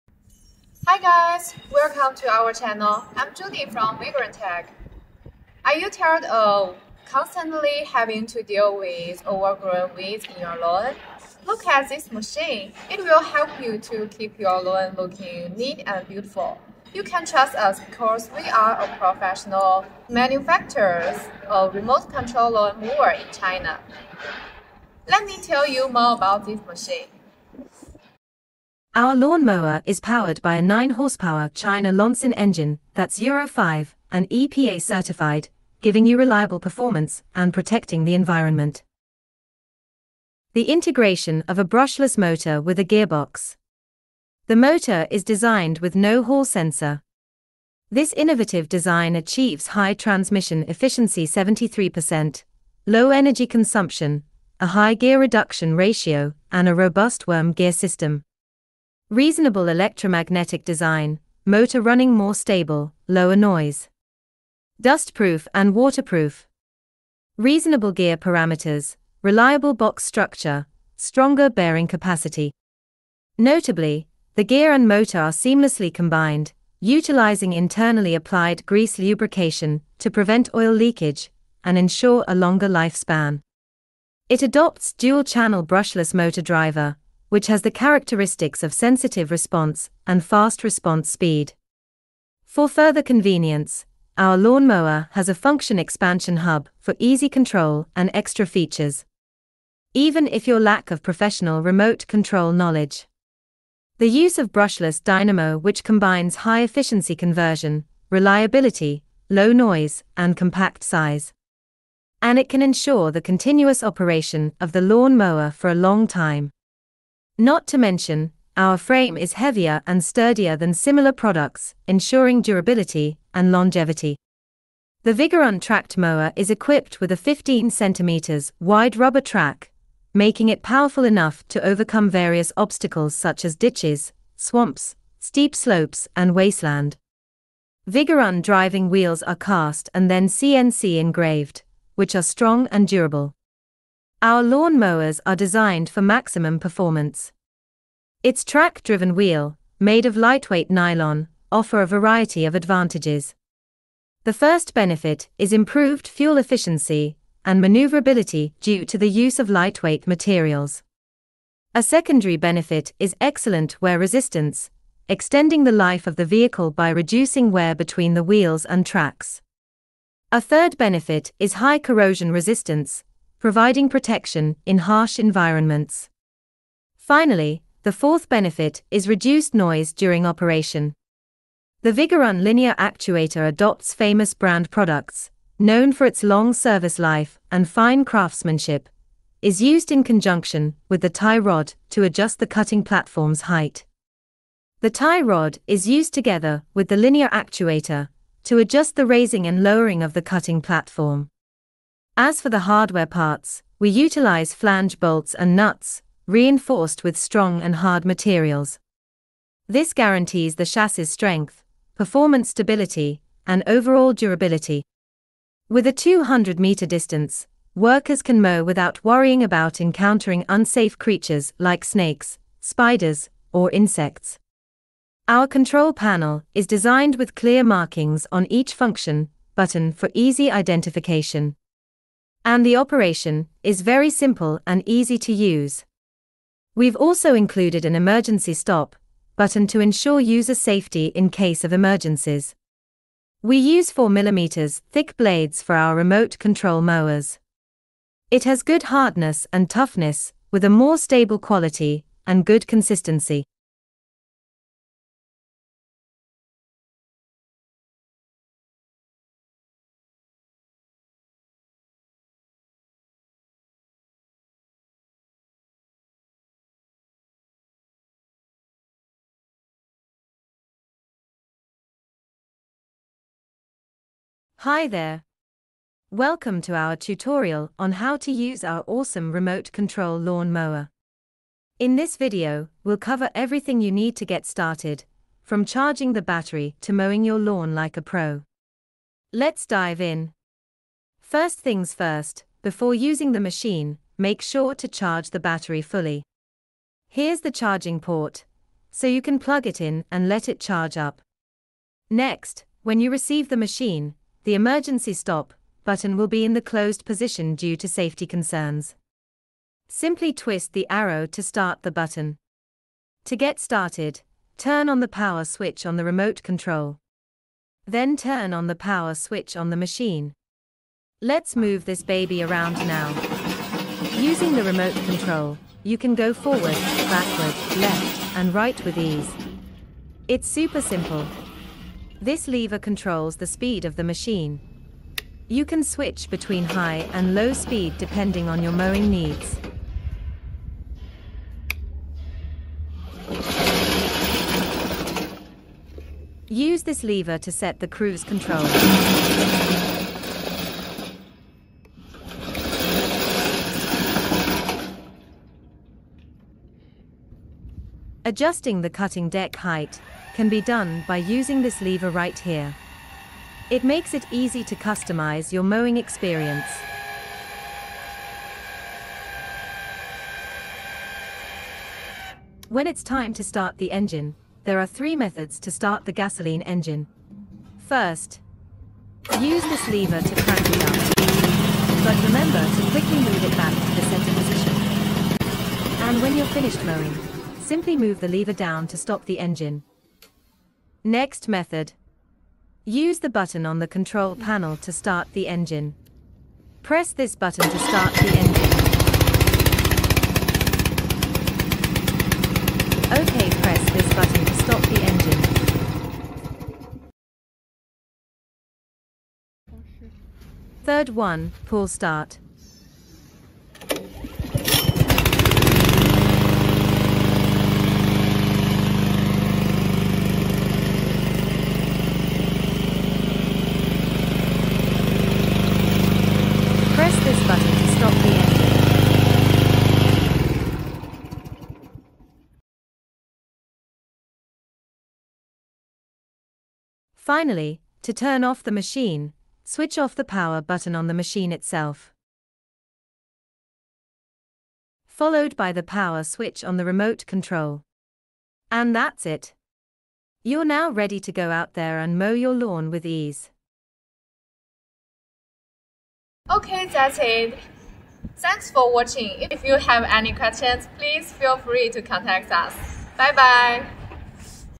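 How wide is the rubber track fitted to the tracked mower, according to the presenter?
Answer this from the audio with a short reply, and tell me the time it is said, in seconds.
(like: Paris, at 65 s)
15 cm, at 127 s.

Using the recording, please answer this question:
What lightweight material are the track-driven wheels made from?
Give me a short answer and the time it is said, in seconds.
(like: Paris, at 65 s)
nylon, at 150 s.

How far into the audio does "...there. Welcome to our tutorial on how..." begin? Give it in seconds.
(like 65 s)
274 s.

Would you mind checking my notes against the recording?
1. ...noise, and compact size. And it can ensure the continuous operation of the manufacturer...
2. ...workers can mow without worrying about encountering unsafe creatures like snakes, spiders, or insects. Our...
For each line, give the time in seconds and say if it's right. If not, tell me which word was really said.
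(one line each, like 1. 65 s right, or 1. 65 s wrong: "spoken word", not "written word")
1. 109 s wrong: "lawnmower", not "manufacturer"
2. 217 s right.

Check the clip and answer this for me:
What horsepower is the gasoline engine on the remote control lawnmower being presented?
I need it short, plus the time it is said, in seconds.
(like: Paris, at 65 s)
9, at 30 s.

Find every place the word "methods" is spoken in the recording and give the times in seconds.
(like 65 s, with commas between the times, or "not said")
375 s, 391 s.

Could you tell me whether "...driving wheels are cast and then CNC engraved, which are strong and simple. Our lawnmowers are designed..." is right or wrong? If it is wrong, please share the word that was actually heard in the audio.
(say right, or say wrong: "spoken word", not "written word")
wrong: "durable", not "simple".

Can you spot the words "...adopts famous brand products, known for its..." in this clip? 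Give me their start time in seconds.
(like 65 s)
183 s.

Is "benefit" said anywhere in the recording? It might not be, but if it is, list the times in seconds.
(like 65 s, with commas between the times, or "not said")
154 s, 162 s, 170 s, 178 s.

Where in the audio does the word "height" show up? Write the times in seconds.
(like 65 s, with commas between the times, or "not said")
193 s, 359 s.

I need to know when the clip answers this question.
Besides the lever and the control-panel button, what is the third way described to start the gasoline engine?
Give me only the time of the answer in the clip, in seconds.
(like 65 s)
411 s.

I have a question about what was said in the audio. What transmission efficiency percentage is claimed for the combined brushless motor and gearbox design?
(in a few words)
73%.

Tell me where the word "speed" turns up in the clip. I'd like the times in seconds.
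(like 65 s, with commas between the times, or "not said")
91 s, 333 s, 337 s.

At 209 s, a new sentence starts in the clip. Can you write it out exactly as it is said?
This guarantees the chassis strength, performance stability, and overall durability.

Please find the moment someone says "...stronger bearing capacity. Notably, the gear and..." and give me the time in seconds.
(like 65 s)
70 s.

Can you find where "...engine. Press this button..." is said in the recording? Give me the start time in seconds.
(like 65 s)
395 s.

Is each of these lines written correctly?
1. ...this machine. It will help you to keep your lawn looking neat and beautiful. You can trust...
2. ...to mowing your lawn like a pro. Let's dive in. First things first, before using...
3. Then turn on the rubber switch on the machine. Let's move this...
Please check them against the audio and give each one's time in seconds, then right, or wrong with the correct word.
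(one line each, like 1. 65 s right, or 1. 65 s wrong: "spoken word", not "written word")
1. 11 s right
2. 286 s right
3. 317 s wrong: "power", not "rubber".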